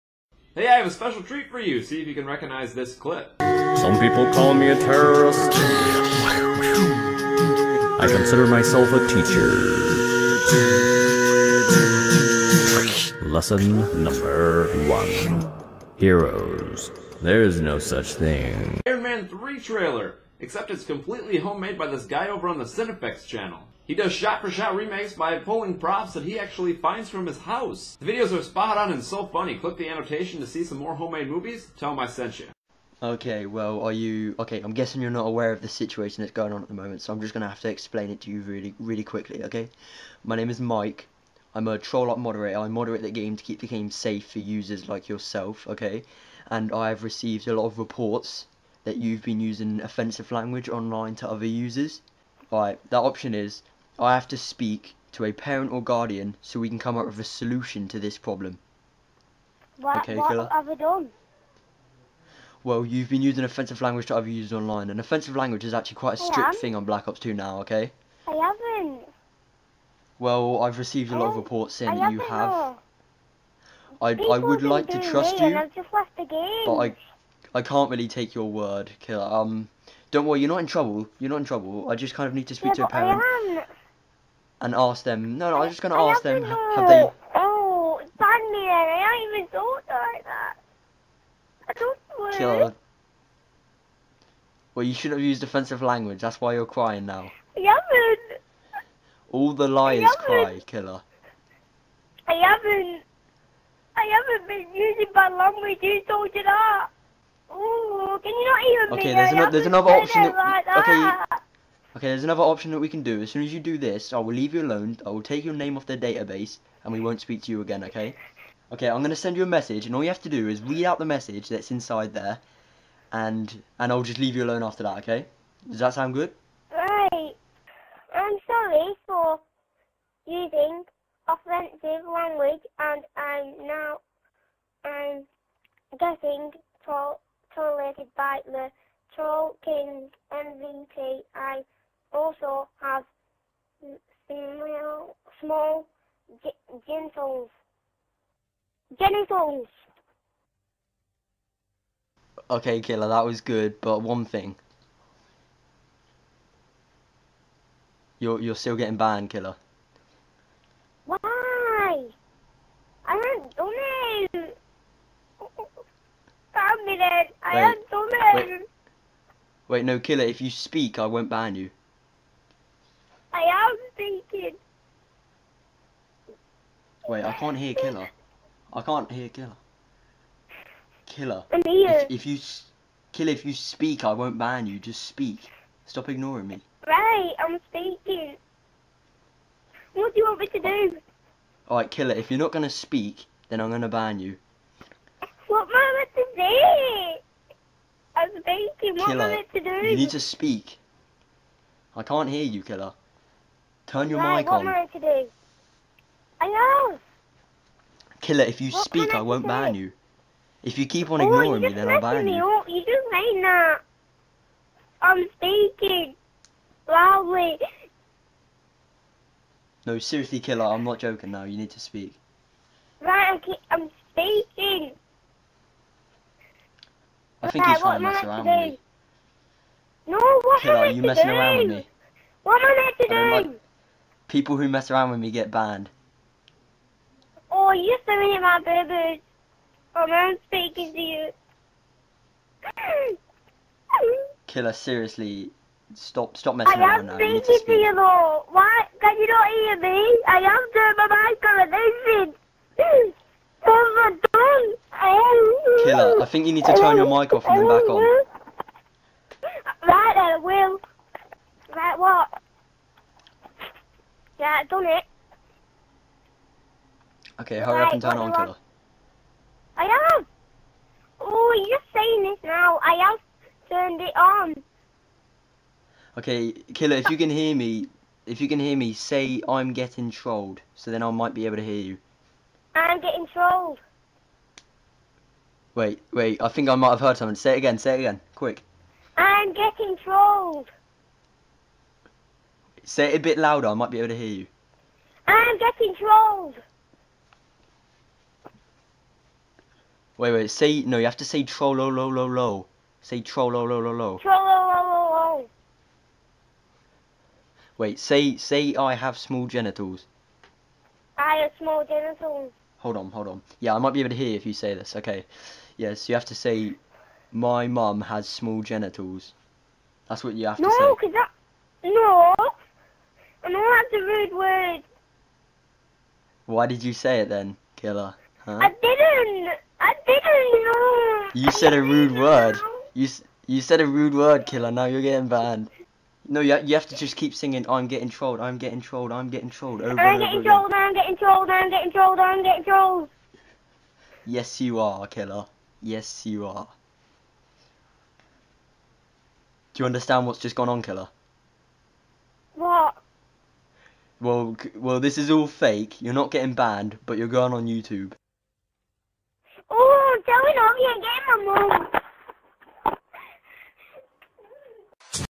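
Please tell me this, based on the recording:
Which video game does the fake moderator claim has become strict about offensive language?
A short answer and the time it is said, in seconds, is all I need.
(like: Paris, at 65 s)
Black Ops 2, at 66 s.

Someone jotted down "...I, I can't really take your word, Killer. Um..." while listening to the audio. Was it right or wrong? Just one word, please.
right.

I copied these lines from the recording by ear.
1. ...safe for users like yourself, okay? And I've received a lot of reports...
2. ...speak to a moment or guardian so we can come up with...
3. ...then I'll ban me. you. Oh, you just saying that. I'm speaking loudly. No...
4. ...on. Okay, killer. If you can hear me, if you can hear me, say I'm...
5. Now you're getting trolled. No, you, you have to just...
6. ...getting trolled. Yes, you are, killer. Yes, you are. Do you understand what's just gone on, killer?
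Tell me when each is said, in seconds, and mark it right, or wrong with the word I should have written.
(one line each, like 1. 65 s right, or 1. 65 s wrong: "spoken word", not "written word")
1. 43 s right
2. 54 s wrong: "parent", not "moment"
3. 211 s right
4. 274 s right
5. 334 s wrong: "banned", not "trolled"
6. 342 s right.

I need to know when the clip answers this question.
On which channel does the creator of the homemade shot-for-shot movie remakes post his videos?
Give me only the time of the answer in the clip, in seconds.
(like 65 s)
22 s.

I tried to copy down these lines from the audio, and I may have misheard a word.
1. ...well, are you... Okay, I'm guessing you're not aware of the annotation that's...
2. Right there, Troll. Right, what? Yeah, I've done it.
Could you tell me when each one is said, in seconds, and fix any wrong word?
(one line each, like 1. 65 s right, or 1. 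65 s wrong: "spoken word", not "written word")
1. 33 s wrong: "situation", not "annotation"
2. 259 s wrong: "Will", not "Troll".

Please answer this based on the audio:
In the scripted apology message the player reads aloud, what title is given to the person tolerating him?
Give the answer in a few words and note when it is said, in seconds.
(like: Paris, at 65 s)
Troll King, at 139 s.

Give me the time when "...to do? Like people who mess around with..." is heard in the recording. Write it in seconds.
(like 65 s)
232 s.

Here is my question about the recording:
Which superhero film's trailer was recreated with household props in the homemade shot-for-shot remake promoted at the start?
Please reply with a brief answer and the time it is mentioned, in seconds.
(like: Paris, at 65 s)
Iron Man 3, at 18 s.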